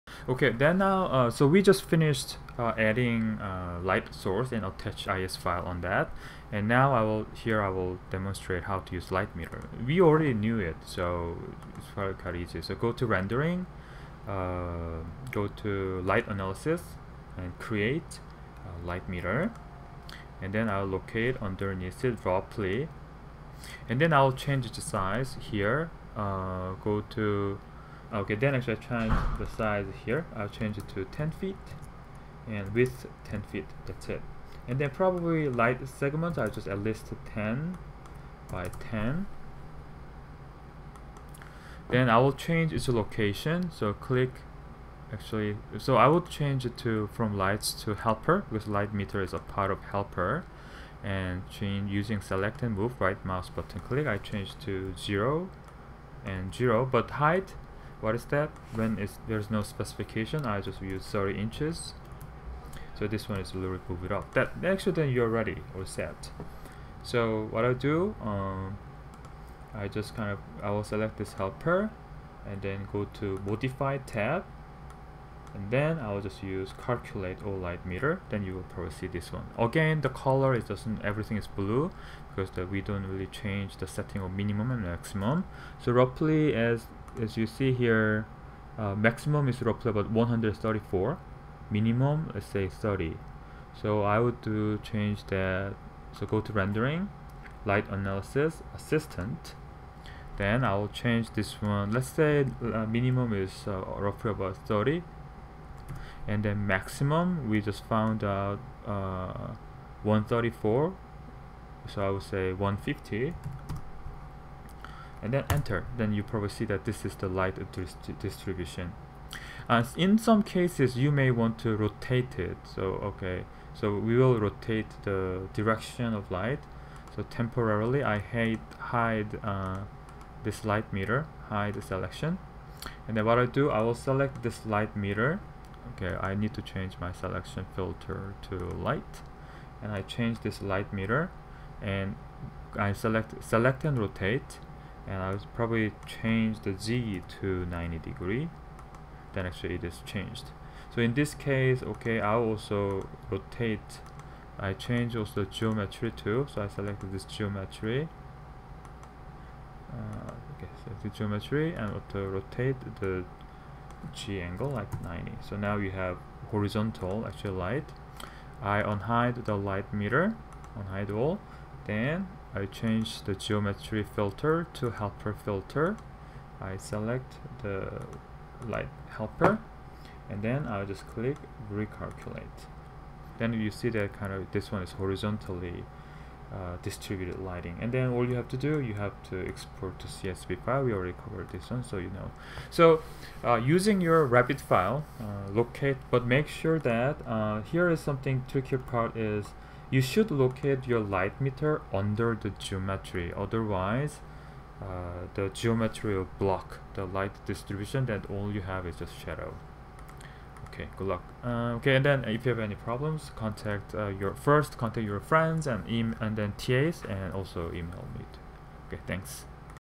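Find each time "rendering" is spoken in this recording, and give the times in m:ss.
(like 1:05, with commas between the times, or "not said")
0:13, 1:36.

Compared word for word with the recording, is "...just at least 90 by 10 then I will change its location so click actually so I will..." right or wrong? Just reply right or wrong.
wrong.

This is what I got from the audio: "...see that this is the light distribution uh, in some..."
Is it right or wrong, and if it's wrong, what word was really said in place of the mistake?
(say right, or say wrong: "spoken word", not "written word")
right.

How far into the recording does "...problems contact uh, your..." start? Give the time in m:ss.
3:32.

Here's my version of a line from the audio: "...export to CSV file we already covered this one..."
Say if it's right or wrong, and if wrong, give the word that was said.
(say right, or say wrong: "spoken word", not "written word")
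right.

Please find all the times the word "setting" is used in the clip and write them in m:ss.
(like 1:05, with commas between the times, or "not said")
1:23.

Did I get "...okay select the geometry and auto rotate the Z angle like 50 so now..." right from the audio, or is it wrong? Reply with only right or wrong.
wrong.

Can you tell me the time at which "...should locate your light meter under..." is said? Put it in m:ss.
3:20.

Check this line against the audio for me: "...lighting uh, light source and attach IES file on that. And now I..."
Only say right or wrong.
wrong.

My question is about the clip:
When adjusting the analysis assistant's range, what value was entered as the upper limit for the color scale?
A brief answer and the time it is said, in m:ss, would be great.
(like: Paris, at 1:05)
150, at 1:52.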